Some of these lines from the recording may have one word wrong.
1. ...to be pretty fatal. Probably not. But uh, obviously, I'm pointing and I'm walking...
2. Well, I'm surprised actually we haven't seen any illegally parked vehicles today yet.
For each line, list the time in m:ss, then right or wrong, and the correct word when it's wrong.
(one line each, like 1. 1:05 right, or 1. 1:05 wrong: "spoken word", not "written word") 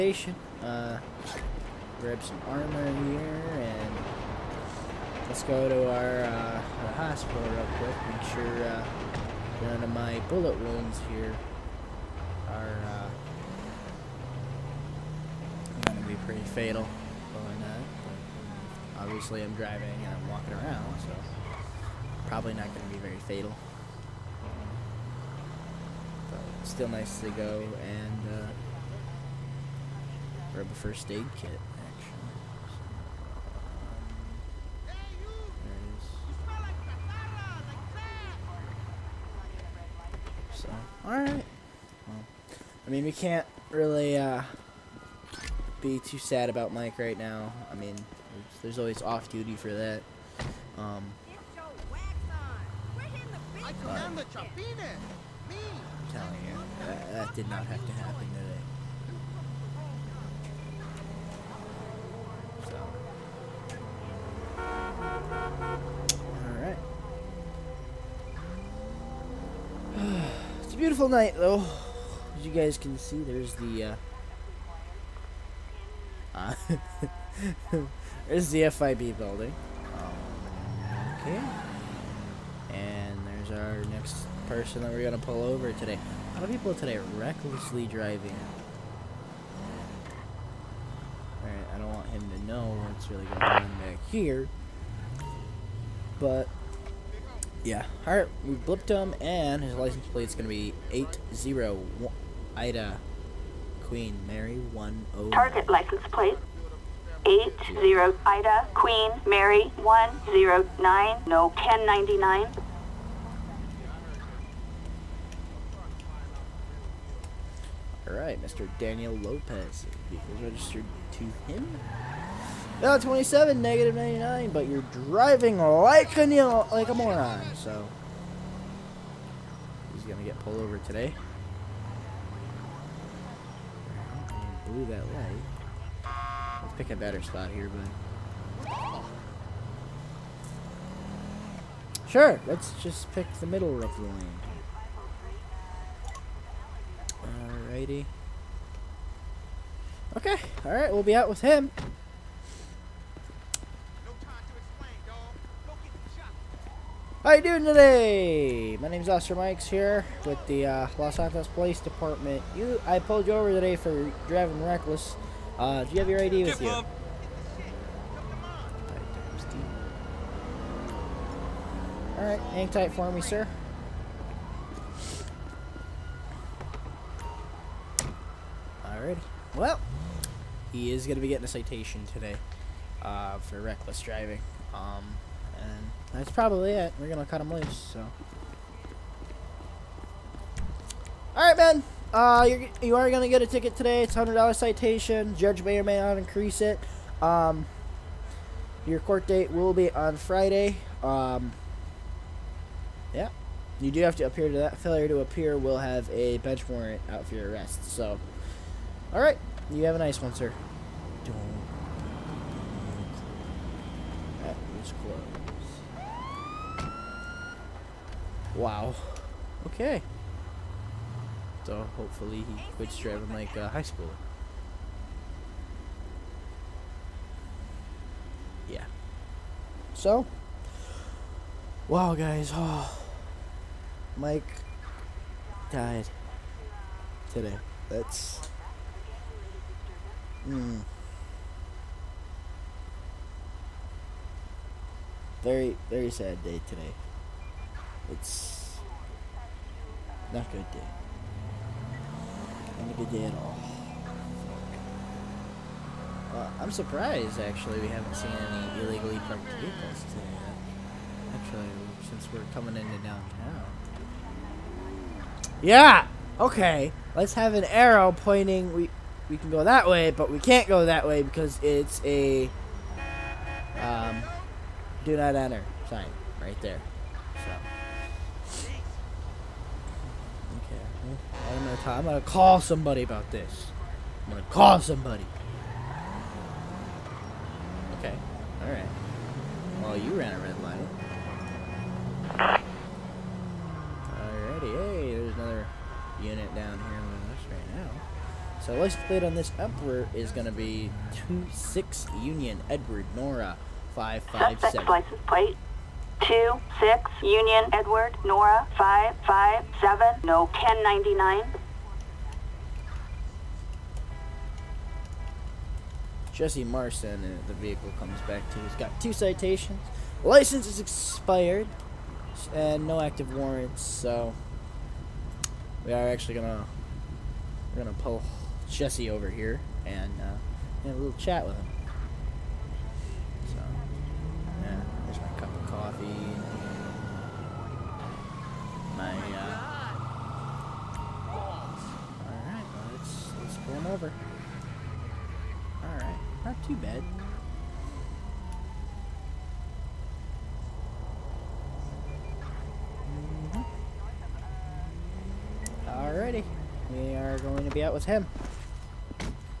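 1. 0:16 wrong: "driving", not "pointing"
2. 4:16 right.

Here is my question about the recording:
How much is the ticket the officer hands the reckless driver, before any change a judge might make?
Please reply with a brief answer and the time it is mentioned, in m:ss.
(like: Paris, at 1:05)
$100, at 3:14.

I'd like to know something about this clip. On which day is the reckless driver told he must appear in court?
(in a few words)
Friday.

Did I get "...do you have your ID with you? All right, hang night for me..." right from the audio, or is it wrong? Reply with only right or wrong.
wrong.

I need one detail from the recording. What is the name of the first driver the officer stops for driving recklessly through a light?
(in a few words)
Daniel Lopez.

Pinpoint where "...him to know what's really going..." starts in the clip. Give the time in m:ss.
1:32.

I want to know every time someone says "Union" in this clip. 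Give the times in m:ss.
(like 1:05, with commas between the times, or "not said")
5:02, 5:07.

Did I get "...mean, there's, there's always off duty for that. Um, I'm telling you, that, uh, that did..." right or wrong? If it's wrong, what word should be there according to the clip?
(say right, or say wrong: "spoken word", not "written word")
right.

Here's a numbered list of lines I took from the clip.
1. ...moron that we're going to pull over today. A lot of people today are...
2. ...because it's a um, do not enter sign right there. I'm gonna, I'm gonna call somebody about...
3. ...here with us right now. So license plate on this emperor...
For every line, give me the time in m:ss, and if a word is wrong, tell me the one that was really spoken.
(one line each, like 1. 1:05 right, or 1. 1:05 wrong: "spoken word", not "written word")
1. 1:24 wrong: "person", not "moron"
2. 4:31 right
3. 4:56 right.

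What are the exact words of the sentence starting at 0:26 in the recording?
But still nice to go and uh, grab a first aid kit.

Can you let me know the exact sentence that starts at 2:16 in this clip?
Let's pick a better spot here, bud.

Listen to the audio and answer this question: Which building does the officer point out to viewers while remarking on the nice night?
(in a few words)
FIB building.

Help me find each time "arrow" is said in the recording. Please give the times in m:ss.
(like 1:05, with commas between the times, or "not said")
4:27.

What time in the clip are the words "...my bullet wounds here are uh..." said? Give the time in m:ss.
0:09.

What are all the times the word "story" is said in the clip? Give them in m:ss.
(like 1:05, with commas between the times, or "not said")
not said.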